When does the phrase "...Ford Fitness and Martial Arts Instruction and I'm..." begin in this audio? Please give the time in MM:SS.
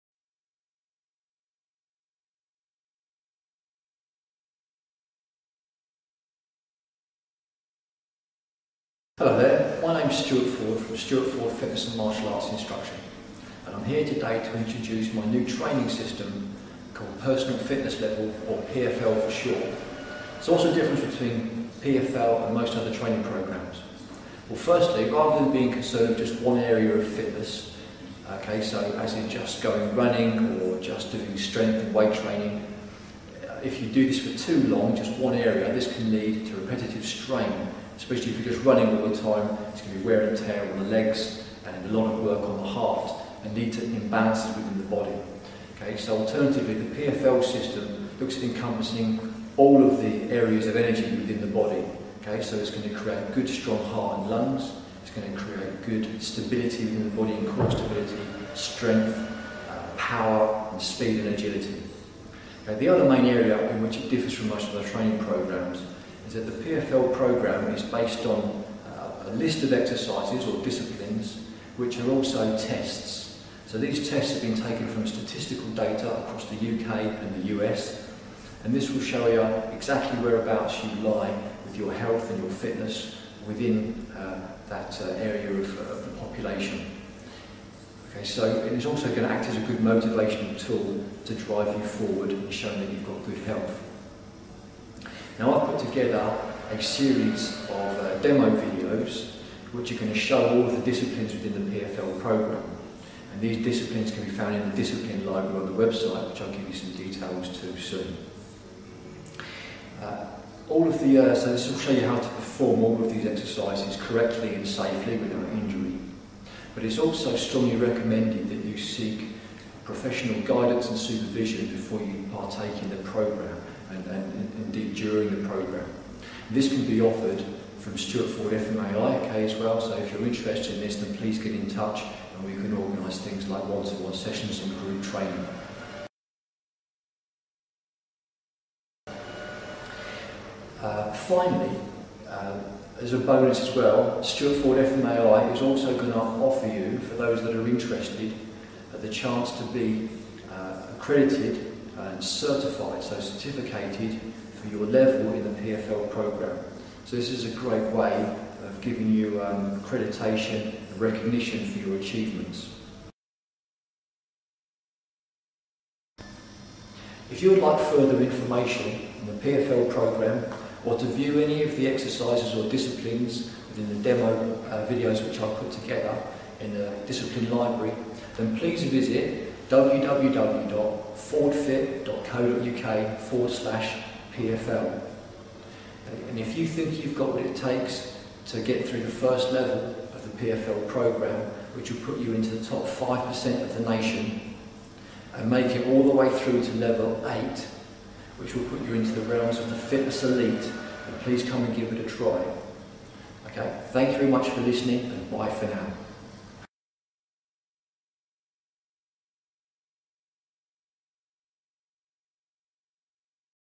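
00:11.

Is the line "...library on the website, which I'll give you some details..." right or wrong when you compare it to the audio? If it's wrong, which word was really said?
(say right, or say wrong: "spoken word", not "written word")
right.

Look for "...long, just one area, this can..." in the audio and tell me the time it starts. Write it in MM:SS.
00:34.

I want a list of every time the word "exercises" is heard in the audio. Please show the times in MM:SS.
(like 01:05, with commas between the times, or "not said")
01:09, 01:53, 02:51.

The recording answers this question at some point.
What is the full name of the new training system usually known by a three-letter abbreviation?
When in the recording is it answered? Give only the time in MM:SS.
00:17.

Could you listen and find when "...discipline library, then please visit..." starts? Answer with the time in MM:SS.
02:57.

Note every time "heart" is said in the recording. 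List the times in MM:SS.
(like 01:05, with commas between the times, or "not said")
00:42, 00:53.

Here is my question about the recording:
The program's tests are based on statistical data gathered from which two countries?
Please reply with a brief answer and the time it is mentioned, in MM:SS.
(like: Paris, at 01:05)
the UK and the US, at 01:16.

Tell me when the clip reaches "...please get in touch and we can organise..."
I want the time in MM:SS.
02:11.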